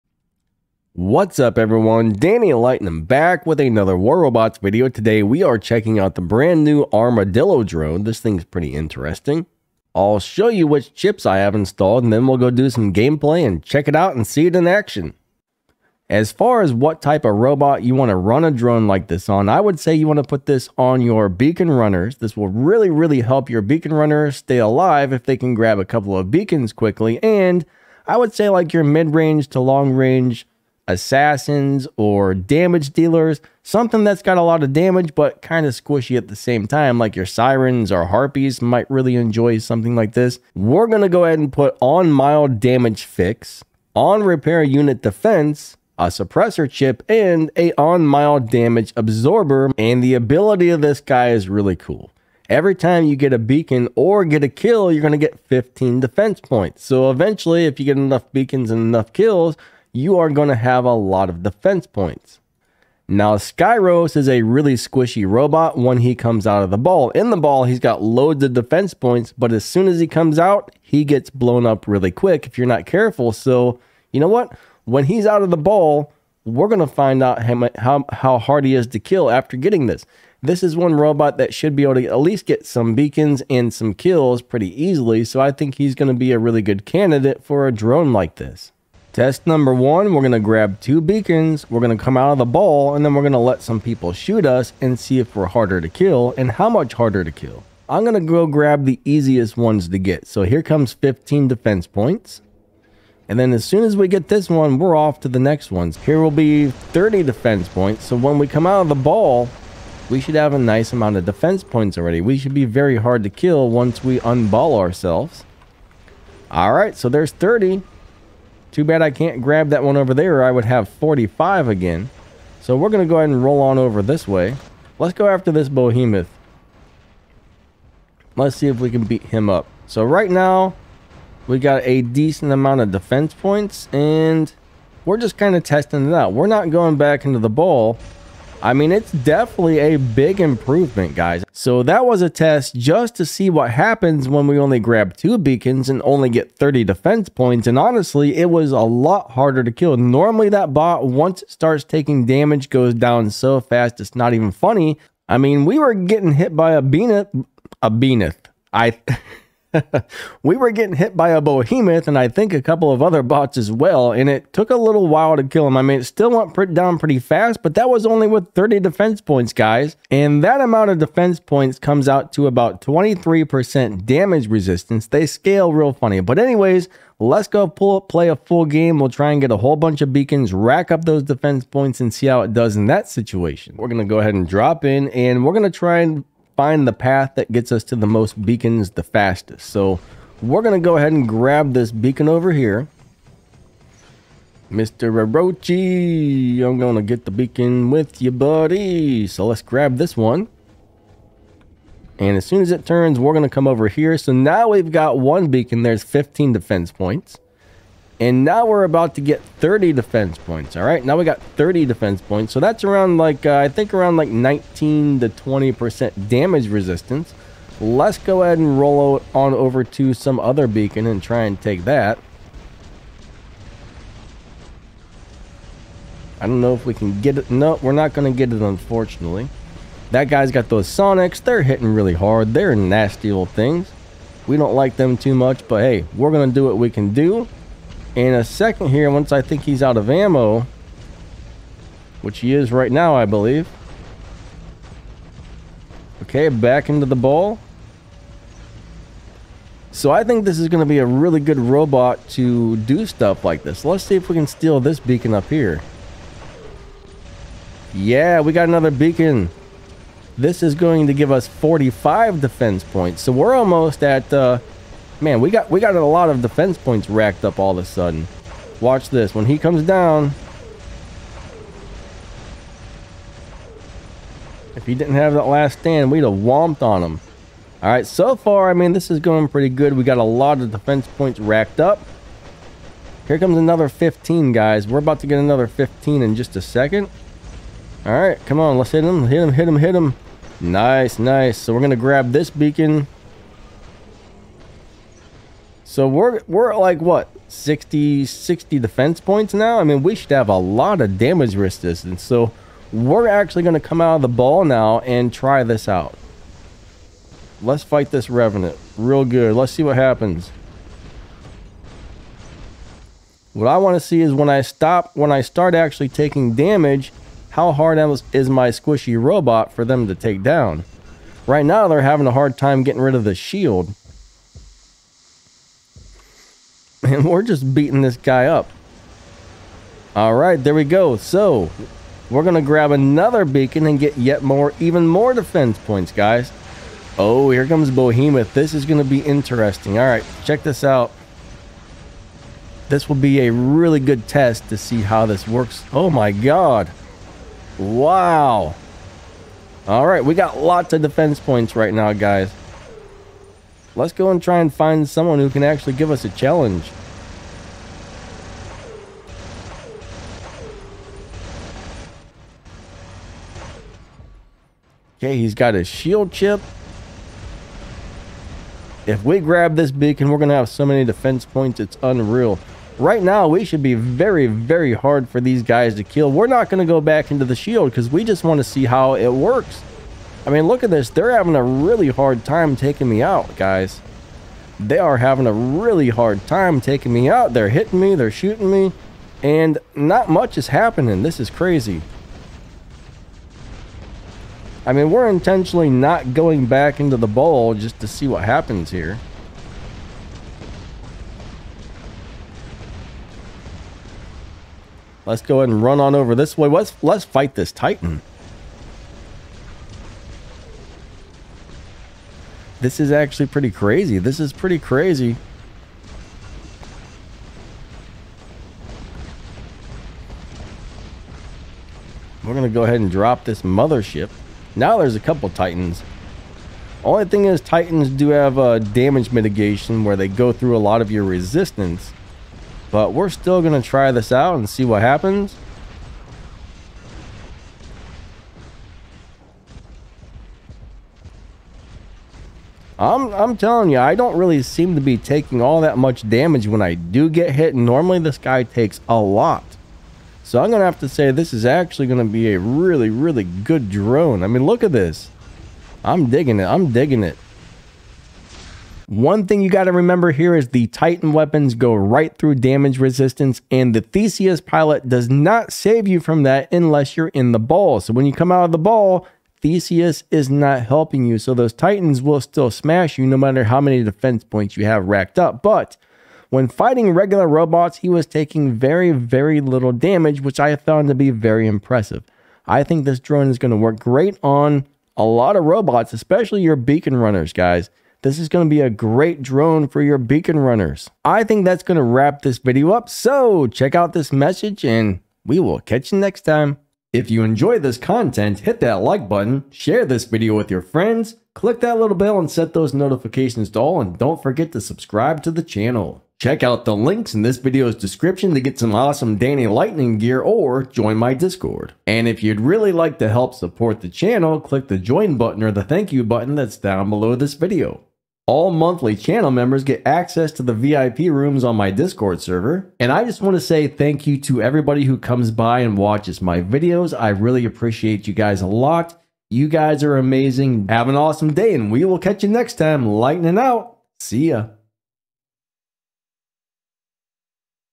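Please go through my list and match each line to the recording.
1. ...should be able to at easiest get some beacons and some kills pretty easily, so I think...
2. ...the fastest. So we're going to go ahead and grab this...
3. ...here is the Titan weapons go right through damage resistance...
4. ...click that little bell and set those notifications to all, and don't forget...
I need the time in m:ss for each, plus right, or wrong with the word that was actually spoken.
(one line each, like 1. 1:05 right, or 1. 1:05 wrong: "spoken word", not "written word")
1. 1:21 wrong: "least", not "easiest"
2. 3:08 right
3. 7:40 right
4. 8:21 right.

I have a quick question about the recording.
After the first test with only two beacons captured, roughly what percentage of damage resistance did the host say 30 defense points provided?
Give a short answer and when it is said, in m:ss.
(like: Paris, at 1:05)
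23%, at 2:52.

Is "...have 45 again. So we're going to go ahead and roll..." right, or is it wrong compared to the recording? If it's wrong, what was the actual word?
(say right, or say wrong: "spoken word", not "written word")
right.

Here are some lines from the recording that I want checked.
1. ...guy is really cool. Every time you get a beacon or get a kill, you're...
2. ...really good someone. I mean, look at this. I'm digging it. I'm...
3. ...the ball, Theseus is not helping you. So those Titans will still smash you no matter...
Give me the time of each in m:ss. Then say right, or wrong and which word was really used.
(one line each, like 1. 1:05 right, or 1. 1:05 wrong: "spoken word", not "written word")
1. 0:51 right
2. 7:33 wrong: "drone", not "someone"
3. 7:48 right.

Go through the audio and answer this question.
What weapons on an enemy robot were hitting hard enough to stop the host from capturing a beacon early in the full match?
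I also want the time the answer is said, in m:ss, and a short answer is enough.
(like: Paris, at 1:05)
Sonics, at 3:50.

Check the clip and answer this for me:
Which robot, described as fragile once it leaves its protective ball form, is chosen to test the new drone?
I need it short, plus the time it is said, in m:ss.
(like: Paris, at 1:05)
Skyros, at 1:03.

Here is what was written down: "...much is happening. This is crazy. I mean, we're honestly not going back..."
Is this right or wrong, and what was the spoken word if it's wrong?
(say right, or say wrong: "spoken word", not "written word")
wrong: "intentionally", not "honestly".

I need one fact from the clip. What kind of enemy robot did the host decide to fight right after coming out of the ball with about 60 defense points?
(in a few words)
Revenant.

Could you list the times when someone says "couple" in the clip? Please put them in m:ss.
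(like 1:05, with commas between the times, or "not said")
0:25, 2:42, 7:05.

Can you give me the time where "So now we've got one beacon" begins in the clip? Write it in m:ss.
3:24.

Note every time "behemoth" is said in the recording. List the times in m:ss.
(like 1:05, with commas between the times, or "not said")
2:05, 2:41.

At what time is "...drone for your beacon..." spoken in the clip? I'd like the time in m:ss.
8:09.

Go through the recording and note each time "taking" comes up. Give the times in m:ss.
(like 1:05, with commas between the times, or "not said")
2:31, 5:16, 6:22, 6:26, 7:25, 7:58.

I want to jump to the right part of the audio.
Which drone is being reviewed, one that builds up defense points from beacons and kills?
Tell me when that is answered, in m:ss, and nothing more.
0:06.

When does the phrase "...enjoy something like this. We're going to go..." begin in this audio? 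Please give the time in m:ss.
0:39.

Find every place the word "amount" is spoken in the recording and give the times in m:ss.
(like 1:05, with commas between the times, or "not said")
1:50, 2:12, 2:50.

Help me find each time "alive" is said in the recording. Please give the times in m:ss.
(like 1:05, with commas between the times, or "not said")
0:24.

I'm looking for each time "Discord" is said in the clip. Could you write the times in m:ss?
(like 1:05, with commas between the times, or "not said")
8:31, 8:41.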